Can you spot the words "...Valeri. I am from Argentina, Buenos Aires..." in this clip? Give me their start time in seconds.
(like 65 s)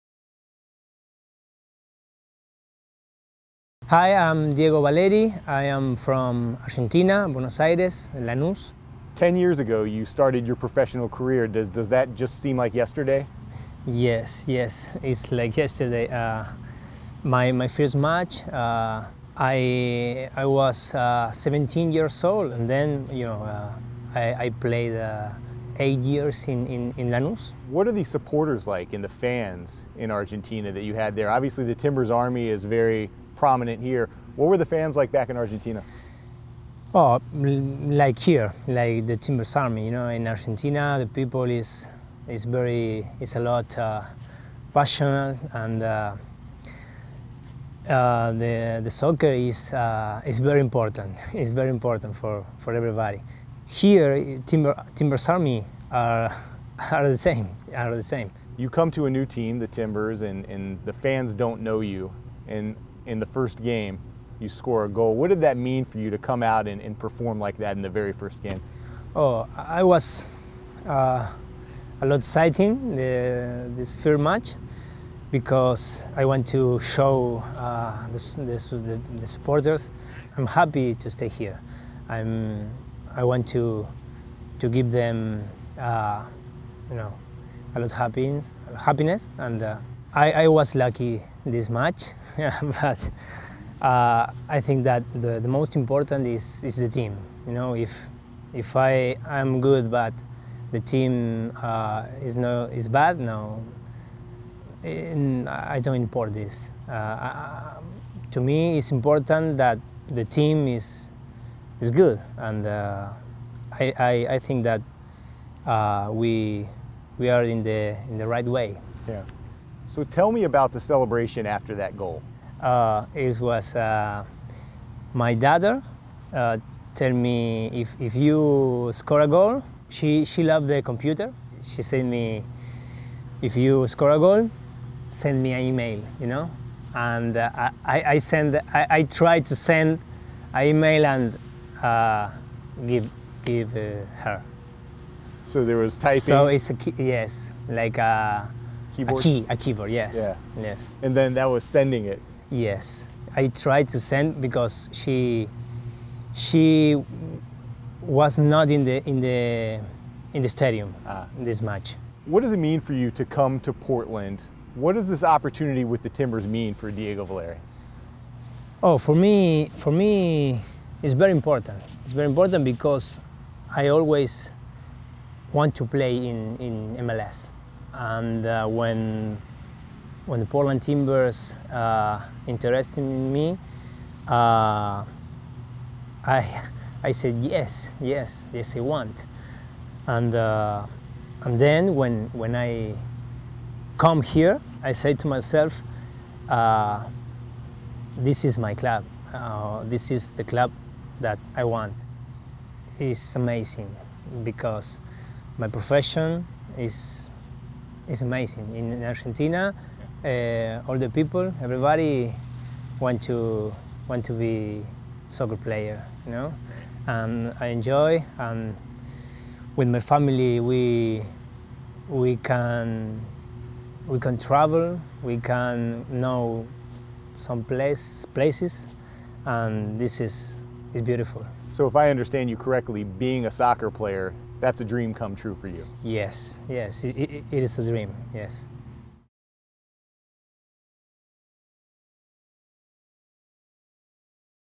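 4 s.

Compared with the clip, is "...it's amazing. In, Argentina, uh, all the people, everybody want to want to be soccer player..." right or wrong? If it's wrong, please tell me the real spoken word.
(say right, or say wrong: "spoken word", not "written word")
right.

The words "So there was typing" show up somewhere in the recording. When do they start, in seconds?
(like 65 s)
145 s.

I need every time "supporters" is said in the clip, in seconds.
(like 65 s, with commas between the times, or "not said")
28 s, 79 s.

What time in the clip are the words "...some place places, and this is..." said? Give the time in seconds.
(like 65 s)
227 s.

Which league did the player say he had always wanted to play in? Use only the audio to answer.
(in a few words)
MLS.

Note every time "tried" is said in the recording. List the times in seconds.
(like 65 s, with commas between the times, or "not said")
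139 s, 153 s.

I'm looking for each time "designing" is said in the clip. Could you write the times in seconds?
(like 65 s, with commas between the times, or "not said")
not said.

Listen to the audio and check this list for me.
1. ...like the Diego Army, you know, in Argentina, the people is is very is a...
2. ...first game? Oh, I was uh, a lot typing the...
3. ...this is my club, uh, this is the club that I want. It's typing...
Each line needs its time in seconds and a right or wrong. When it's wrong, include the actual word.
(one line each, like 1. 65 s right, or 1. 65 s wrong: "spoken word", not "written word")
1. 38 s wrong: "Timbers", not "Diego"
2. 68 s wrong: "exciting", not "typing"
3. 198 s wrong: "amazing", not "typing".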